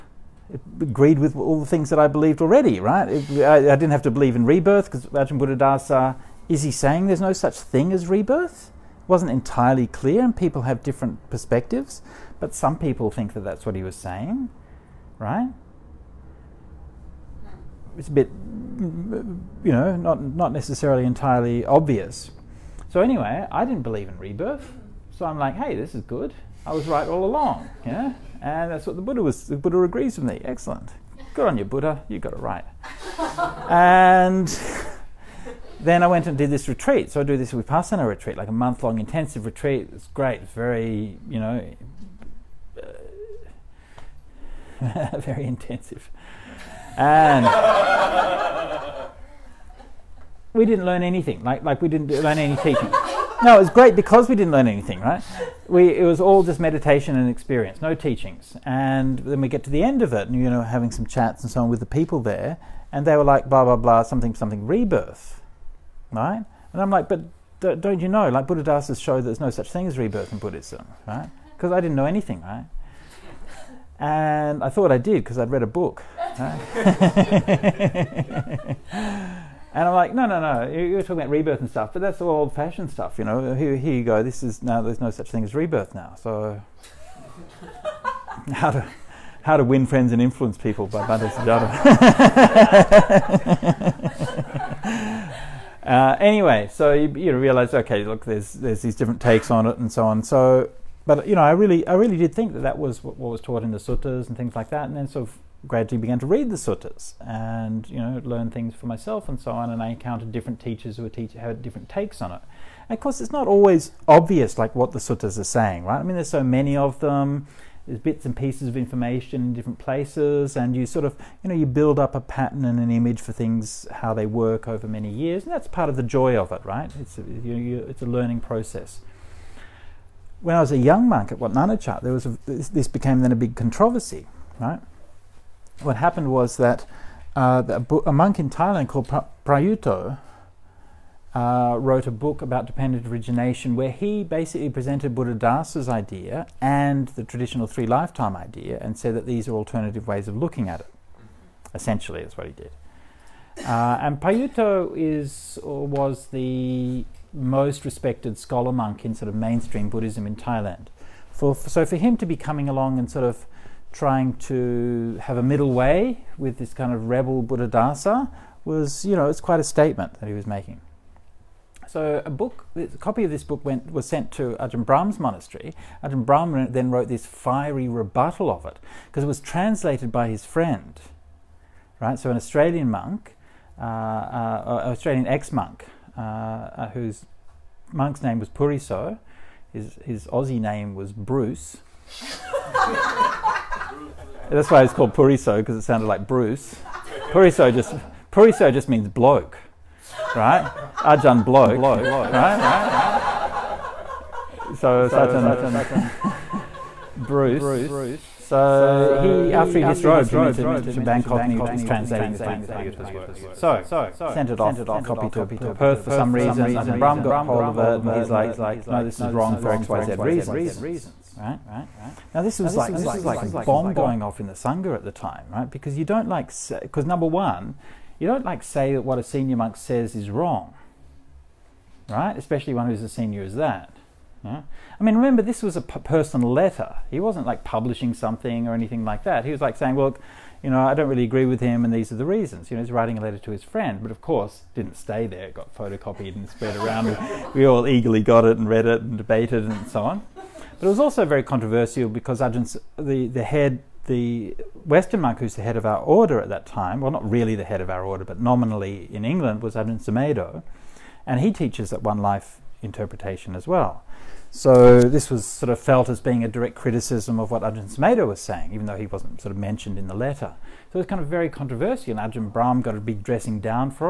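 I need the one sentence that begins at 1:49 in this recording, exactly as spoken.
And I encountered different teachers who were teach- had different takes on it.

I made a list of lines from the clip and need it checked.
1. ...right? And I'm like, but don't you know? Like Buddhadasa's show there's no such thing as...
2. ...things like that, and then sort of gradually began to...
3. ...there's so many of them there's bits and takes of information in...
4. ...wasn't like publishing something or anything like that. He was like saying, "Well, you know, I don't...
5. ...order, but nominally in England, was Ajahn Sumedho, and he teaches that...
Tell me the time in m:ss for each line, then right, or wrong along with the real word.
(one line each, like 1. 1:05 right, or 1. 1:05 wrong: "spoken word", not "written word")
1. 1:06 right
2. 1:44 right
3. 1:56 wrong: "pieces", not "takes"
4. 3:57 right
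5. 4:18 right.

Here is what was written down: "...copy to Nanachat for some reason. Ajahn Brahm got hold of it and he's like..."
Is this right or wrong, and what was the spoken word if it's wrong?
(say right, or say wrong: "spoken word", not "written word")
wrong: "Perth", not "Nanachat".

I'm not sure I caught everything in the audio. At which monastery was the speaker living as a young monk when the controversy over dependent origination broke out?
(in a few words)
Wat Nanachat.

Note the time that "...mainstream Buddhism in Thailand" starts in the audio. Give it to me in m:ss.
2:39.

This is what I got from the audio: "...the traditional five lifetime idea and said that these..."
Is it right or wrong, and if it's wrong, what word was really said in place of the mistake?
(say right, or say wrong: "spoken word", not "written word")
wrong: "three", not "five".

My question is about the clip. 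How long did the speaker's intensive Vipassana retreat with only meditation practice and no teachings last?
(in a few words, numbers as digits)
a month.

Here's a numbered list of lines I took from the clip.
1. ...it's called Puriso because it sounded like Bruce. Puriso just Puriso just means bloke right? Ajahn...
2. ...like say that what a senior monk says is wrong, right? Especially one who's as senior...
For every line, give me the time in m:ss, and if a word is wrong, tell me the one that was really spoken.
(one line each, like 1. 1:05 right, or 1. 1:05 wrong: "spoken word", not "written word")
1. 3:14 right
2. 3:48 right.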